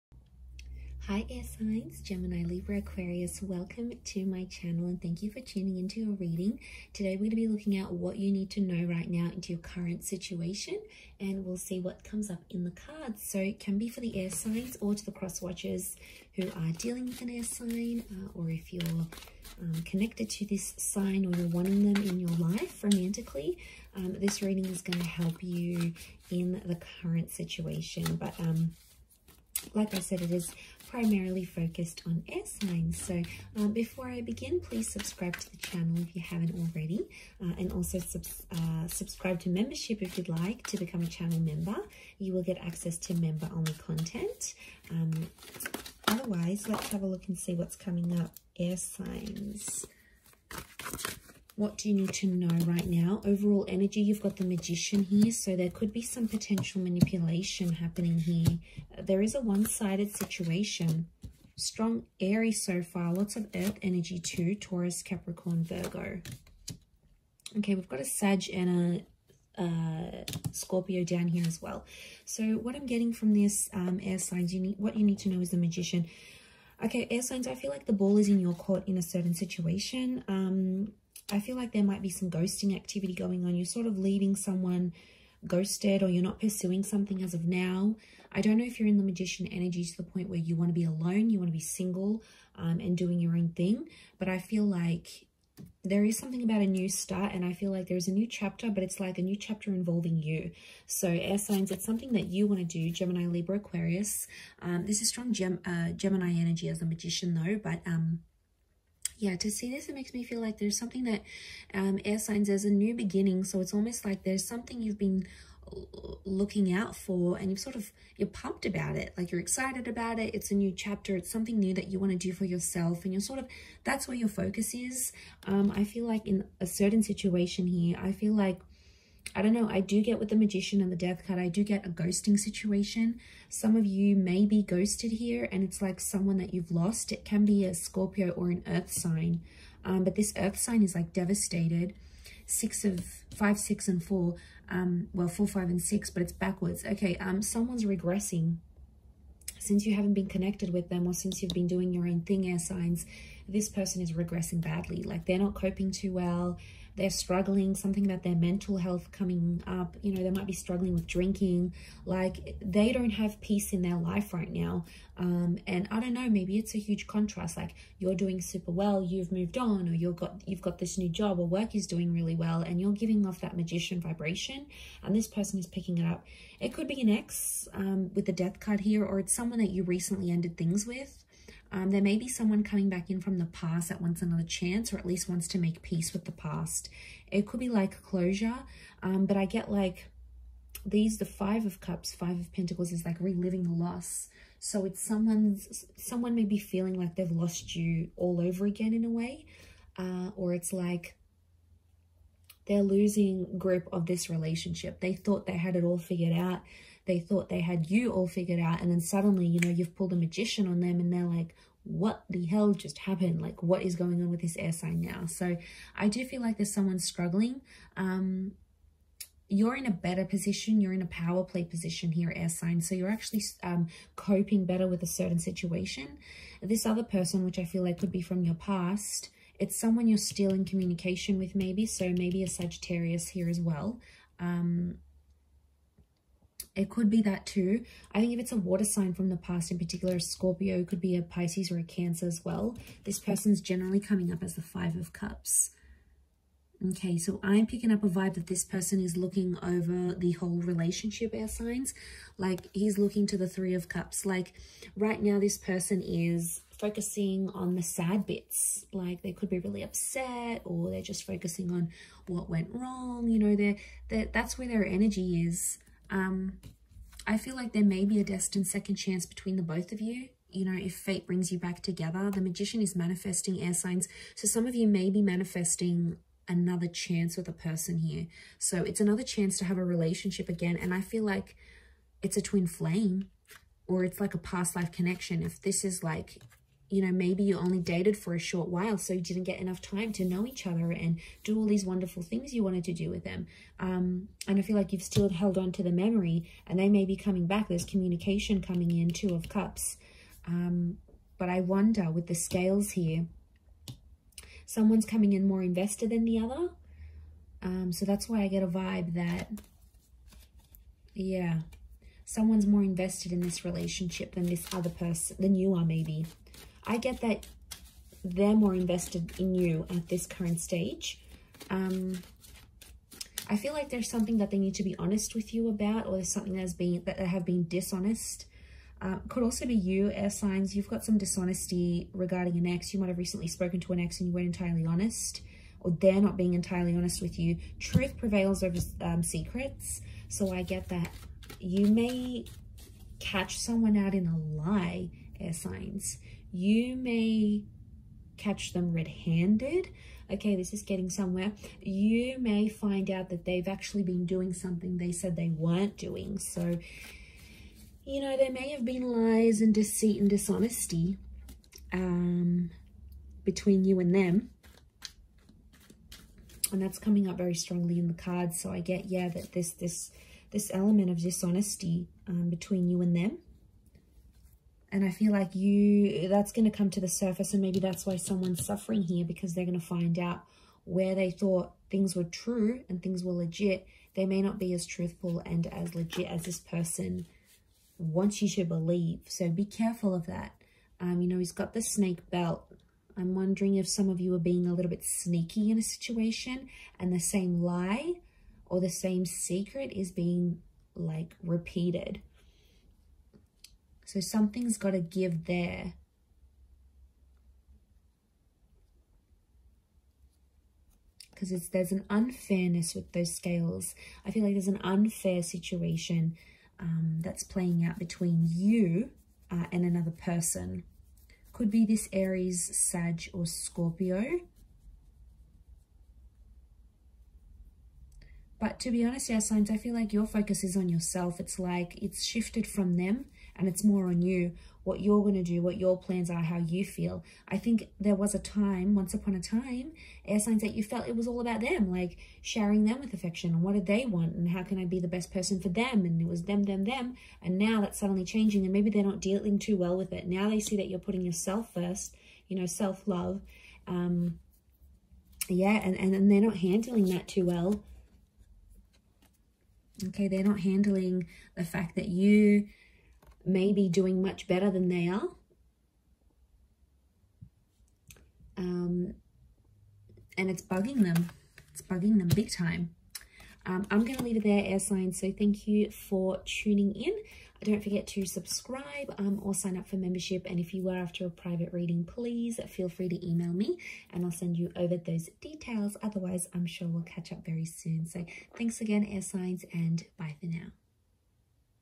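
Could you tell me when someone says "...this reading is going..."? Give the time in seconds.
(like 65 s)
24 s.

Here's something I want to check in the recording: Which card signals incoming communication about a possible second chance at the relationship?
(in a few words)
Two of Cups.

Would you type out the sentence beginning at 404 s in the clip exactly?
So something's got to give there.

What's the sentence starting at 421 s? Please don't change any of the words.
Could be this Aries, Sag, or Scorpio.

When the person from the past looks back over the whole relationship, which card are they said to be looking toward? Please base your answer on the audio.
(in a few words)
Three of Cups.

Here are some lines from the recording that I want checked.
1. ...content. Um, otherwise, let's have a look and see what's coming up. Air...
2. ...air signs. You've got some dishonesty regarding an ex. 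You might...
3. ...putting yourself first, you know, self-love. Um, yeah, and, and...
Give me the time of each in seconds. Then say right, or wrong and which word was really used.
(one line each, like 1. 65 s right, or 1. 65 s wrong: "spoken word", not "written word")
1. 43 s right
2. 330 s right
3. 450 s right.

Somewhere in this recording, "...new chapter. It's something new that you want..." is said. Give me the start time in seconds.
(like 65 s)
120 s.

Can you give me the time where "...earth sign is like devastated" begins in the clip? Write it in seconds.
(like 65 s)
140 s.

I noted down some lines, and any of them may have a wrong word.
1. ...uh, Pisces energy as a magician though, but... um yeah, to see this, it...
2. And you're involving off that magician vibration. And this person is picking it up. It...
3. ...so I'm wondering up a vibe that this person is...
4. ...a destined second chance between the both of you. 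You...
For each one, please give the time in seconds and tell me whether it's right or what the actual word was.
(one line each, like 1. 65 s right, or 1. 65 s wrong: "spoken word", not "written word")
1. 105 s wrong: "Gemini", not "Pisces"
2. 172 s wrong: "giving", not "involving"
3. 247 s wrong: "picking", not "wondering"
4. 268 s right.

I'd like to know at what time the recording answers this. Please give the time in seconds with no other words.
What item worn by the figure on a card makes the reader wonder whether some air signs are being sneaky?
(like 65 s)
391 s.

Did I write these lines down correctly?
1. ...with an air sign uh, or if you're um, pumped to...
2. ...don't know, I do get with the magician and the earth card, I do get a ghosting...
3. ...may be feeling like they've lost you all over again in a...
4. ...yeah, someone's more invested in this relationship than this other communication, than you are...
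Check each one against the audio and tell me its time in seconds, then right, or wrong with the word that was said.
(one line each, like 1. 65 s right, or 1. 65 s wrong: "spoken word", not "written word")
1. 17 s wrong: "connected", not "pumped"
2. 129 s wrong: "death", not "earth"
3. 196 s right
4. 311 s wrong: "person", not "communication".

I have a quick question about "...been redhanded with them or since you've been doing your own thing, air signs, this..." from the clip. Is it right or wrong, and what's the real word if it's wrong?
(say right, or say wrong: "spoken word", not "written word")
wrong: "connected", not "redhanded".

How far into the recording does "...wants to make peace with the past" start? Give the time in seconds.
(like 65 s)
185 s.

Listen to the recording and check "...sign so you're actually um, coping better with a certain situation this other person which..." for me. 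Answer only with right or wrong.
right.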